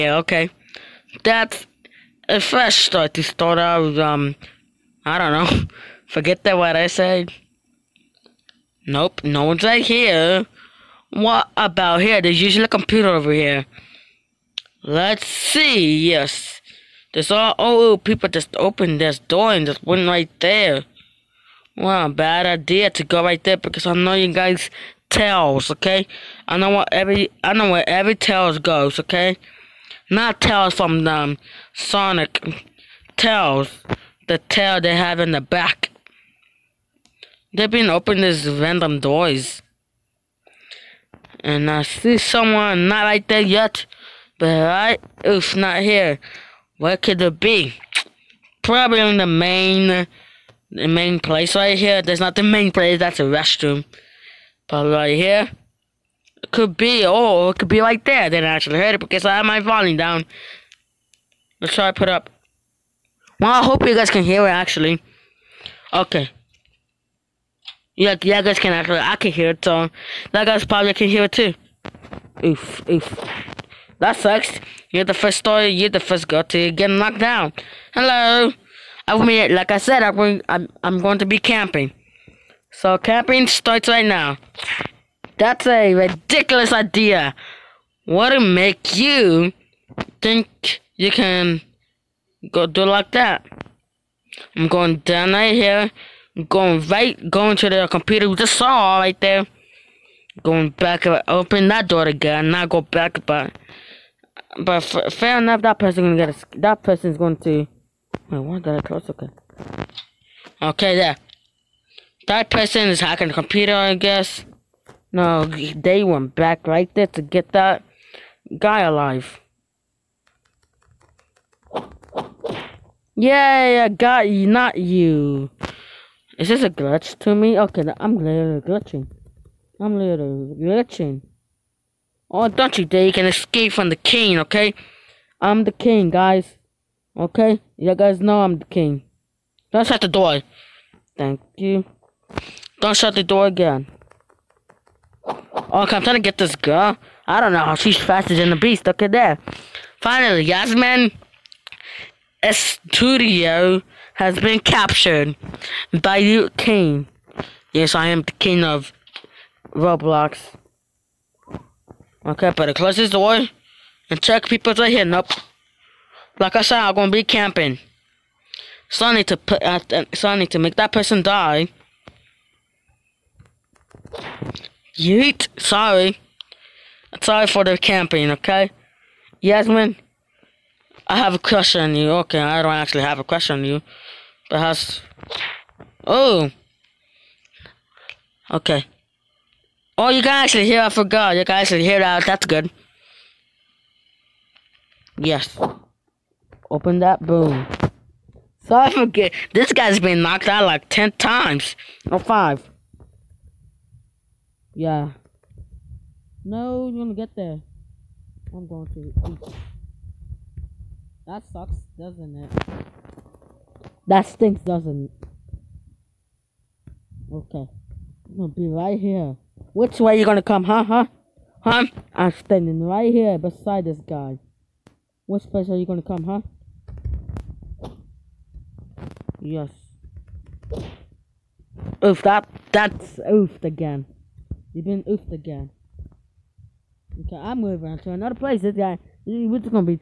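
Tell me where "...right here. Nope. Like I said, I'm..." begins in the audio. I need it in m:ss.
2:44.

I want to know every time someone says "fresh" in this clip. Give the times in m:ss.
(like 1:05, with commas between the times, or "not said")
0:02.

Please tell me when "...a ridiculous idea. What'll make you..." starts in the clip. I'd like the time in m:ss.
1:25.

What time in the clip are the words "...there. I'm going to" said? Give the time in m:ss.
3:27.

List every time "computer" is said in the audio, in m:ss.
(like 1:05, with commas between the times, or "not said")
0:12, 1:37, 1:53.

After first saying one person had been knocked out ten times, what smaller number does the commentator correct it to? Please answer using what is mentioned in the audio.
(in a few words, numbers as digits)
5.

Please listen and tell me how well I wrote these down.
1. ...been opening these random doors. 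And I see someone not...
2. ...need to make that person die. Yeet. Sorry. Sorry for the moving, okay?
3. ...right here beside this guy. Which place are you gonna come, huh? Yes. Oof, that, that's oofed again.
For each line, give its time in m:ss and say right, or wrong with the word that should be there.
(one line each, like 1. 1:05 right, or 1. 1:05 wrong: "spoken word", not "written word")
1. 0:37 right
2. 2:50 wrong: "camping", not "moving"
3. 3:42 right.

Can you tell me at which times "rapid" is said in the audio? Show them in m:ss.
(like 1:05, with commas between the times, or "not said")
not said.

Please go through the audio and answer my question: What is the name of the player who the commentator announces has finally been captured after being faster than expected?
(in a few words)
Yasmin Studio.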